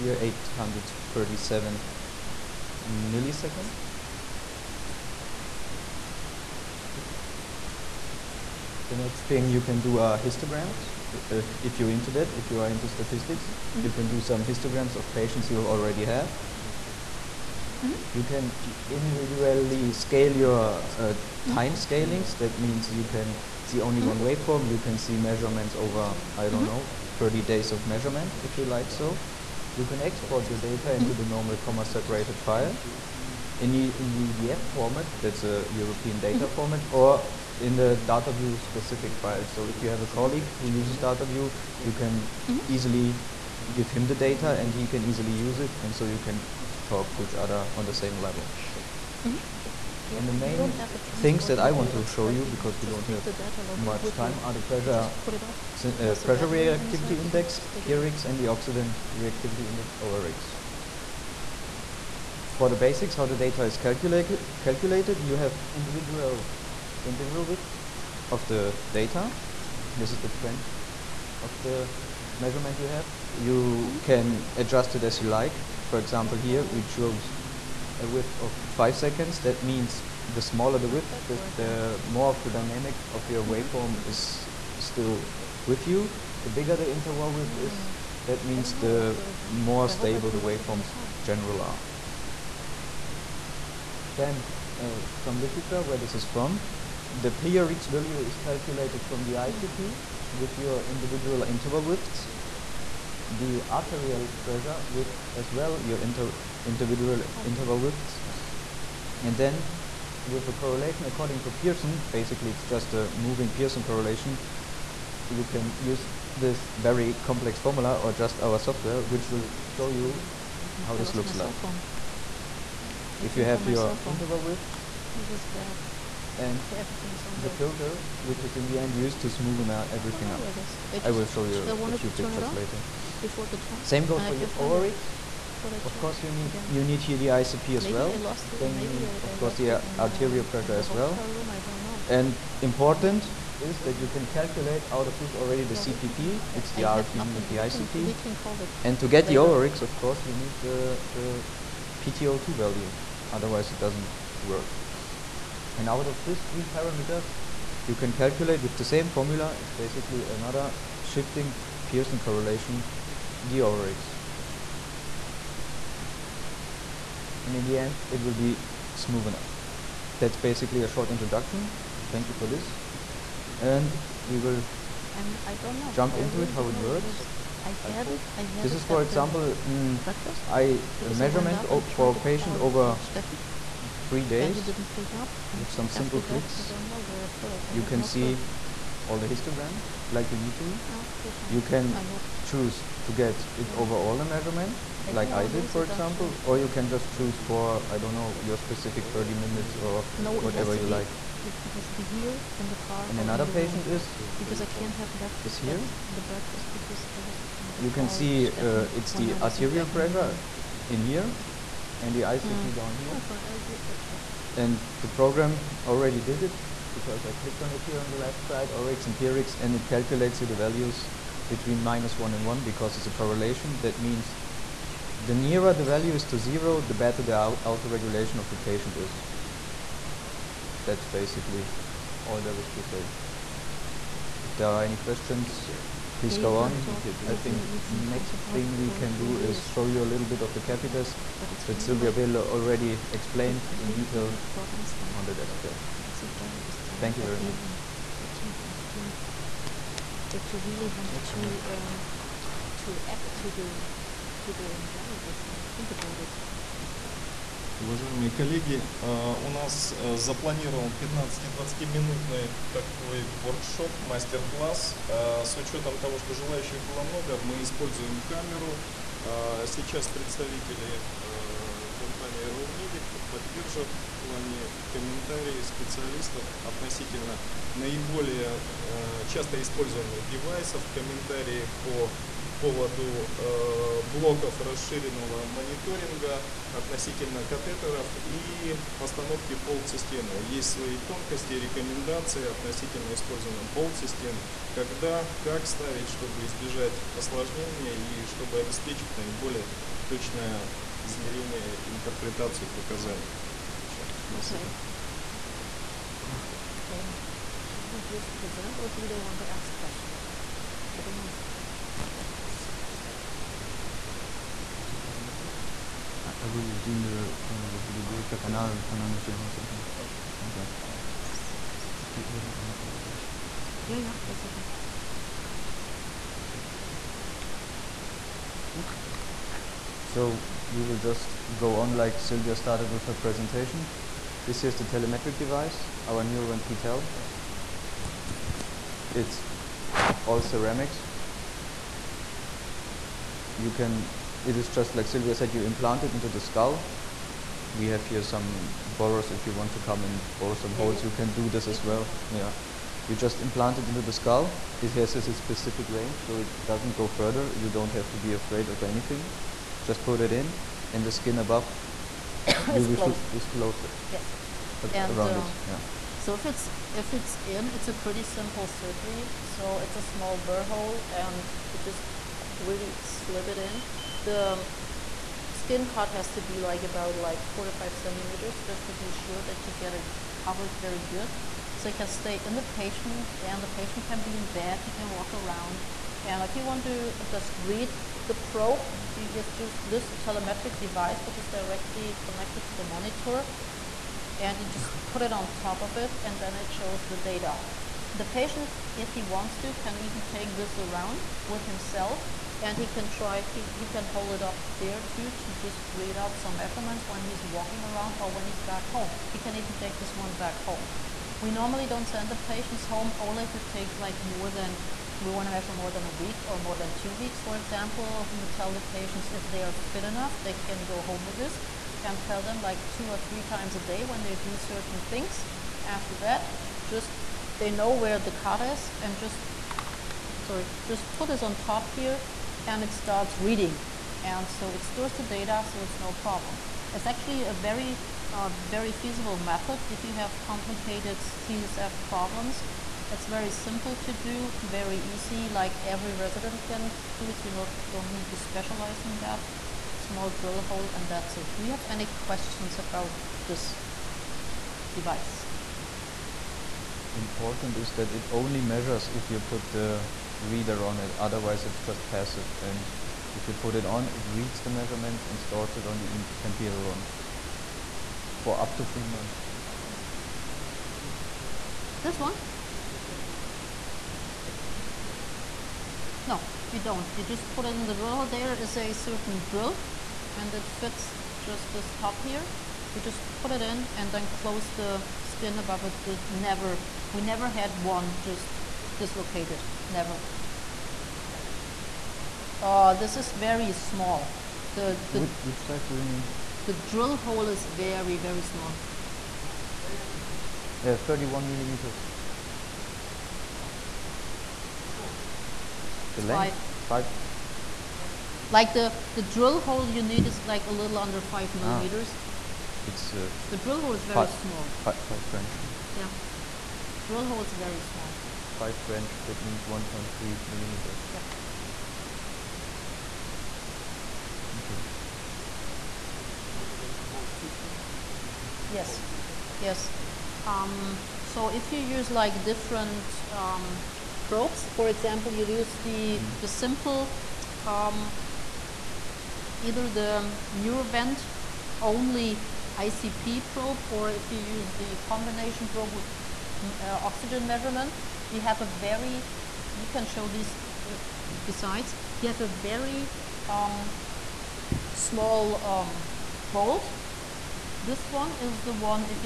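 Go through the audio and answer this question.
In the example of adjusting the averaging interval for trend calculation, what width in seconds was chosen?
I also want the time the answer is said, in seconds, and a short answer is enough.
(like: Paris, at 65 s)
5 seconds, at 78 s.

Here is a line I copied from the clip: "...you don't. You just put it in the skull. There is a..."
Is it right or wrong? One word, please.
wrong.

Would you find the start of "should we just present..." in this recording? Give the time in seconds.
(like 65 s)
307 s.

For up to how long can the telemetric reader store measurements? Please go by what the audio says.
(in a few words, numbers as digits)
3 months.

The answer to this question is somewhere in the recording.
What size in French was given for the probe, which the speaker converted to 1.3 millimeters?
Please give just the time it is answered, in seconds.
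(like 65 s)
514 s.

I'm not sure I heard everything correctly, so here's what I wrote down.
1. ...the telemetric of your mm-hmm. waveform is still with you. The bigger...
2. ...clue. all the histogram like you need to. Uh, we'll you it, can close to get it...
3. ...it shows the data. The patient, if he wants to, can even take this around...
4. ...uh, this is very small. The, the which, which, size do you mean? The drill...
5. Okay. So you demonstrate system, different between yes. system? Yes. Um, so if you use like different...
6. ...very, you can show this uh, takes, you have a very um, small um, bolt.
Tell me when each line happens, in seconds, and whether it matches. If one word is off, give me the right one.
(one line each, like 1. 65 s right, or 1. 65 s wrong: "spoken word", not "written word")
1. 82 s wrong: "dynamic", not "telemetric"
2. 188 s wrong: "choose", not "close"
3. 396 s right
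4. 492 s right
5. 524 s right
6. 548 s wrong: "besides", not "takes".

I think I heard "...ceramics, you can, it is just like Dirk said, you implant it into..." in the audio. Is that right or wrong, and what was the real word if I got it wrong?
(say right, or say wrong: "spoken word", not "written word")
wrong: "Sylvia", not "Dirk".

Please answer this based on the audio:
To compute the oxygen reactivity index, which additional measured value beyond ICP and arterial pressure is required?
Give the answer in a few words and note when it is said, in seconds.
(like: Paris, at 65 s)
PTO2, at 151 s.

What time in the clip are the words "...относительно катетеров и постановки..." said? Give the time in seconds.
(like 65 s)
286 s.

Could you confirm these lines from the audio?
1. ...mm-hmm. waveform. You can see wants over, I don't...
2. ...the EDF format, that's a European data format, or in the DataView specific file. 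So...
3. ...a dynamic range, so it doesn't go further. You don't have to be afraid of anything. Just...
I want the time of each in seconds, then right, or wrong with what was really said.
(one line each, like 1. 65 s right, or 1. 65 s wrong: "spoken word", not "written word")
1. 24 s wrong: "measurements", not "wants"
2. 34 s right
3. 355 s wrong: "specific", not "dynamic".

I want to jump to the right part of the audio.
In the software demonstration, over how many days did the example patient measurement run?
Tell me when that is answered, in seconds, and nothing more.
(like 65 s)
184 s.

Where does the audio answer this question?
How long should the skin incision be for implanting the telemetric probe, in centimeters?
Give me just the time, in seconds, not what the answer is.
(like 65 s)
377 s.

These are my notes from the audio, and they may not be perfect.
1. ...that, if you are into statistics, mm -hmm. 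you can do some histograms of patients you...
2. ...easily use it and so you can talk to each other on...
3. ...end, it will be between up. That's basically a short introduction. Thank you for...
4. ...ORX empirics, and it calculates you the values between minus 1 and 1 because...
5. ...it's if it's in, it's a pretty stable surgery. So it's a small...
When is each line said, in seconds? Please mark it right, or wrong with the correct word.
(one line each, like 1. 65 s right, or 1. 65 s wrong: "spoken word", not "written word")
1. 12 s right
2. 45 s right
3. 167 s wrong: "smoothen", not "between"
4. 218 s right
5. 366 s wrong: "simple", not "stable".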